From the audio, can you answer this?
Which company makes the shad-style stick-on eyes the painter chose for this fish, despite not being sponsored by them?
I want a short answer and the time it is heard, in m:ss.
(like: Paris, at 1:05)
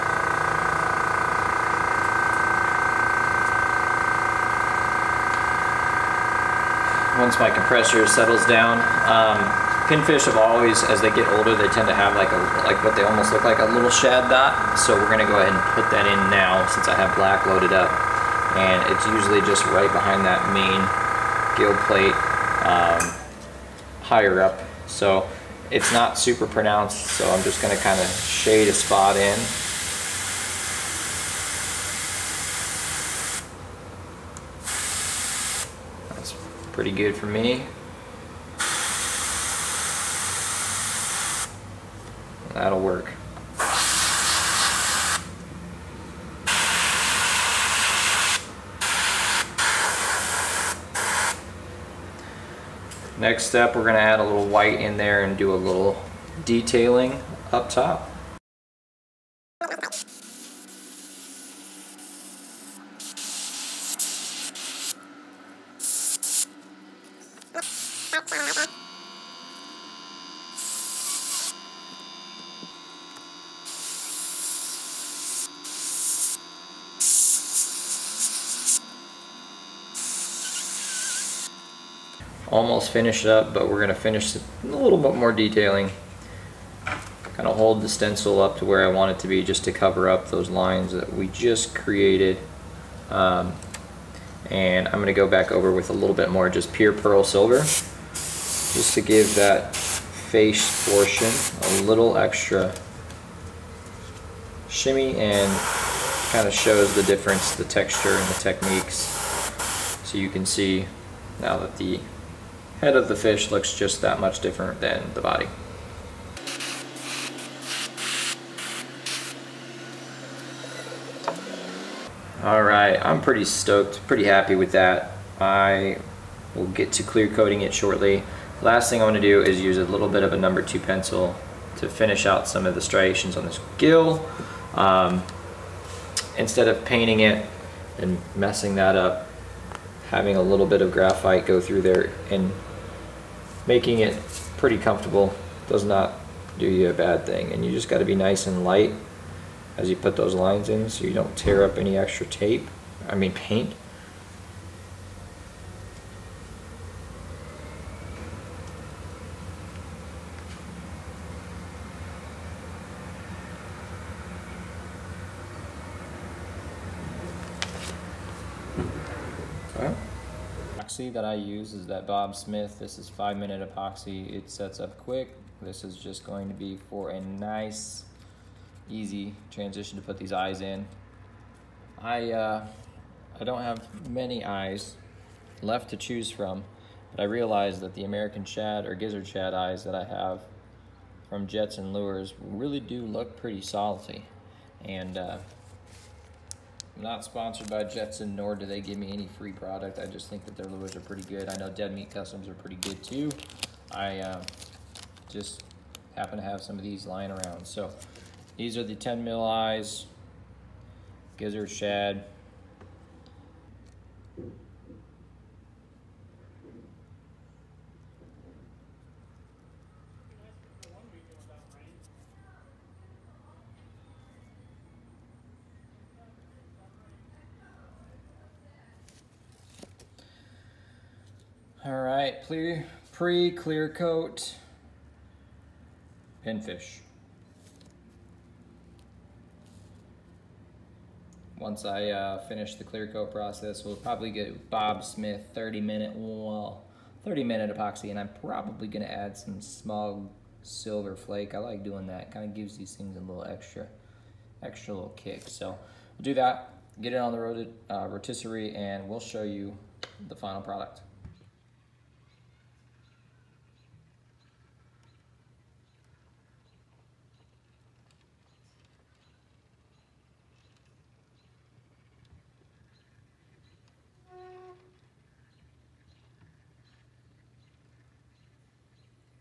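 Jetson Lures, at 3:11.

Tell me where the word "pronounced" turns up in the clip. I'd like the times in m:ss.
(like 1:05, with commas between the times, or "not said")
0:26.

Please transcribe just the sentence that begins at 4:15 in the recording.
So we'll do that, get it on the uh, rotisserie, and we'll show you the final product.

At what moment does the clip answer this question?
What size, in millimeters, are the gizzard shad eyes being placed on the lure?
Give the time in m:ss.
3:28.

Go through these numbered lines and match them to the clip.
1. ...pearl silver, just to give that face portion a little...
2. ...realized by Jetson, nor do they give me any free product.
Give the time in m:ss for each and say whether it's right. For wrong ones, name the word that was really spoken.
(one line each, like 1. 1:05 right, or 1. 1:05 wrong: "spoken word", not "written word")
1. 1:36 right
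2. 3:17 wrong: "sponsored", not "realized".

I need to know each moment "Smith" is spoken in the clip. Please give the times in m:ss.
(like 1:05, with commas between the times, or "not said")
2:52, 4:05.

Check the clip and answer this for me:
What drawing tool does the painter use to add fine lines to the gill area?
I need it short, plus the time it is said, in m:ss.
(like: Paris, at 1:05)
number 2 pencil, at 2:10.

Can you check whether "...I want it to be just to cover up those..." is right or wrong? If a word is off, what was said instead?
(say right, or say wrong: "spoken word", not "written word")
right.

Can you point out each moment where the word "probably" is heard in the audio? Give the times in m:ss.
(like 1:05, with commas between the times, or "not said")
4:03, 4:08.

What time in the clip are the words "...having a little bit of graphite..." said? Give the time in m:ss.
2:20.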